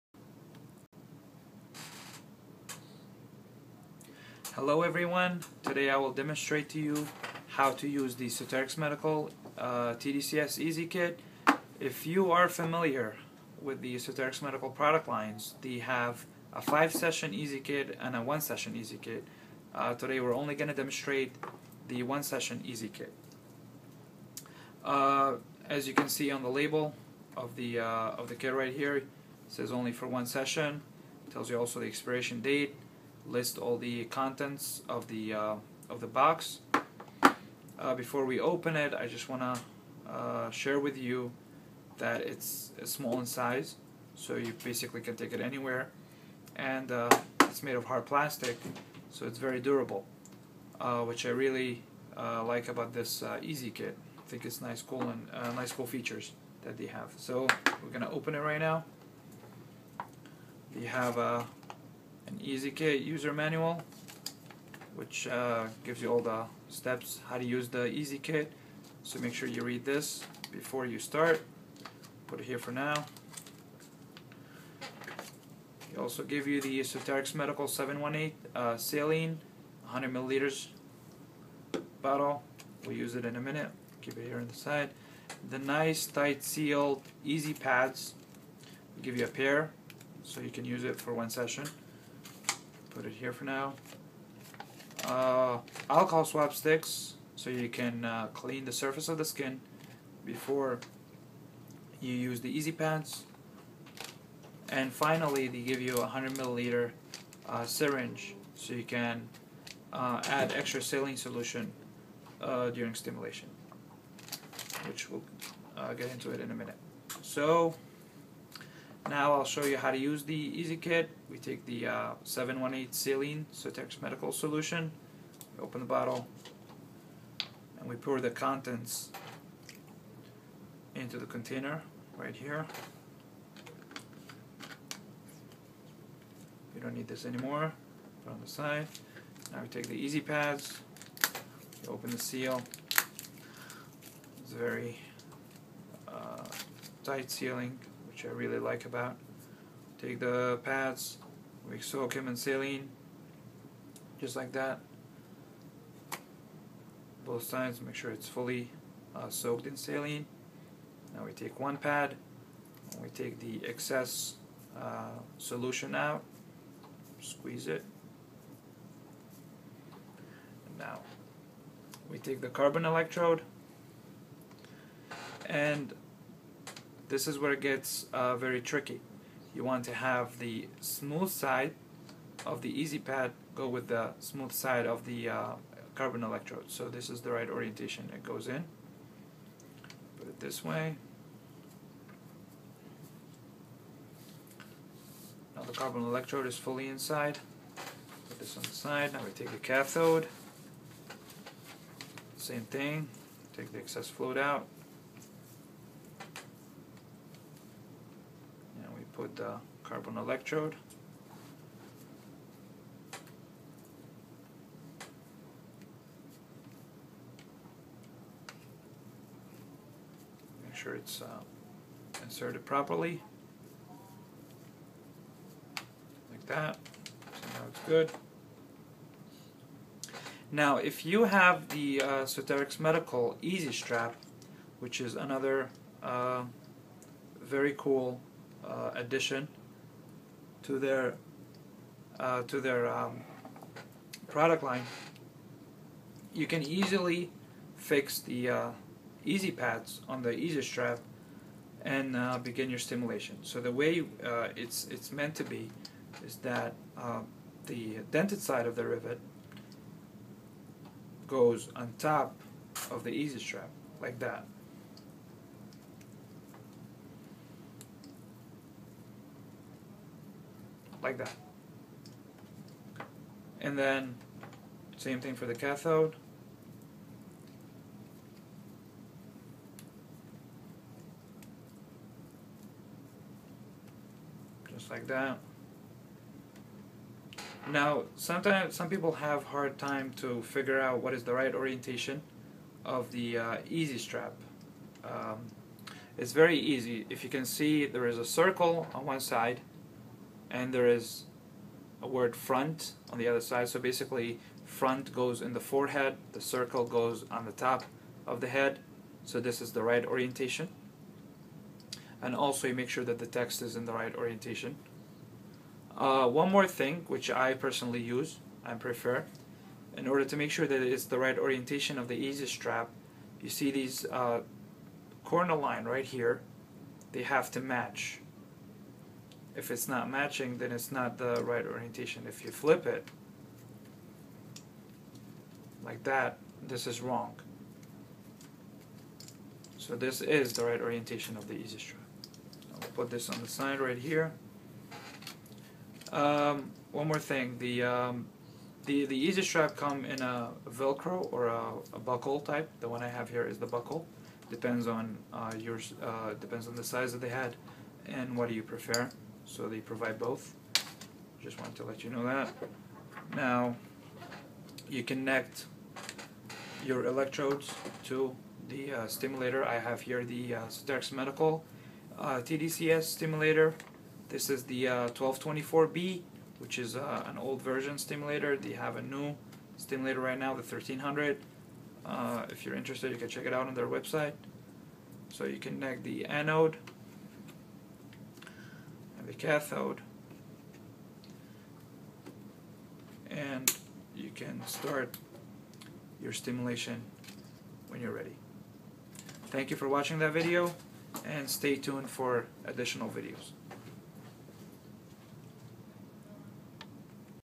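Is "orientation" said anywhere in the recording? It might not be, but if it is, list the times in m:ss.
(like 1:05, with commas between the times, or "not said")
3:07, 4:51, 5:10, 5:14, 5:21, 5:31, 5:40.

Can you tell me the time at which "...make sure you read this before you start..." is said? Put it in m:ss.
1:09.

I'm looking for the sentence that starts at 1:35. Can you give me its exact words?
Uh, alcohol swab sticks so you can uh, clean the surface of the skin before you use the easy pads.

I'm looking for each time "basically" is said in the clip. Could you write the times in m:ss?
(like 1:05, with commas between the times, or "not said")
0:44, 5:03.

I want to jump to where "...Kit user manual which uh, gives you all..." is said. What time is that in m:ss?
1:02.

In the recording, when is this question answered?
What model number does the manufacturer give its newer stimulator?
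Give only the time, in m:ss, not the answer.
6:20.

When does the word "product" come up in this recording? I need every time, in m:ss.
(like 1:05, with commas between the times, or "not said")
0:14, 4:04.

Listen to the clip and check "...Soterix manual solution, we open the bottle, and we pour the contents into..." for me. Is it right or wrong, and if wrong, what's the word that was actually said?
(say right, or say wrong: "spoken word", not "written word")
wrong: "medical", not "manual".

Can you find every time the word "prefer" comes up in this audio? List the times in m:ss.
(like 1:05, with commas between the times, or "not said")
5:18, 5:58.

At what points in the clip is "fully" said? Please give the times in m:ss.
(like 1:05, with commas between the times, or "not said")
2:38, 3:16.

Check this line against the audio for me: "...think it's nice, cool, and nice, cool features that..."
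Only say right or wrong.
right.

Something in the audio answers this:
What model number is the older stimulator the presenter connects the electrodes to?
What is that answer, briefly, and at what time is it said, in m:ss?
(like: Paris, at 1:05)
1224B, at 6:14.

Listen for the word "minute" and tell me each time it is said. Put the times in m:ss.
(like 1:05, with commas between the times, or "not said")
1:23, 1:56.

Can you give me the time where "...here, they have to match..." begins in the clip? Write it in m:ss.
5:26.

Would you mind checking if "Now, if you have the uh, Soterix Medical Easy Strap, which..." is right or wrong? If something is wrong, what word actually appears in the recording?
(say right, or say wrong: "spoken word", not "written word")
right.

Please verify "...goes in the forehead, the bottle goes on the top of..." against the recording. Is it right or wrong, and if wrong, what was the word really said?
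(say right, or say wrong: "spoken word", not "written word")
wrong: "circle", not "bottle".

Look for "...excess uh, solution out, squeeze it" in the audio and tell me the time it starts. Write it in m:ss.
2:43.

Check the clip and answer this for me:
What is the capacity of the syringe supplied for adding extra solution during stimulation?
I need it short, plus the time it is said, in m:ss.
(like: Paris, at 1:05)
100 milliliters, at 1:46.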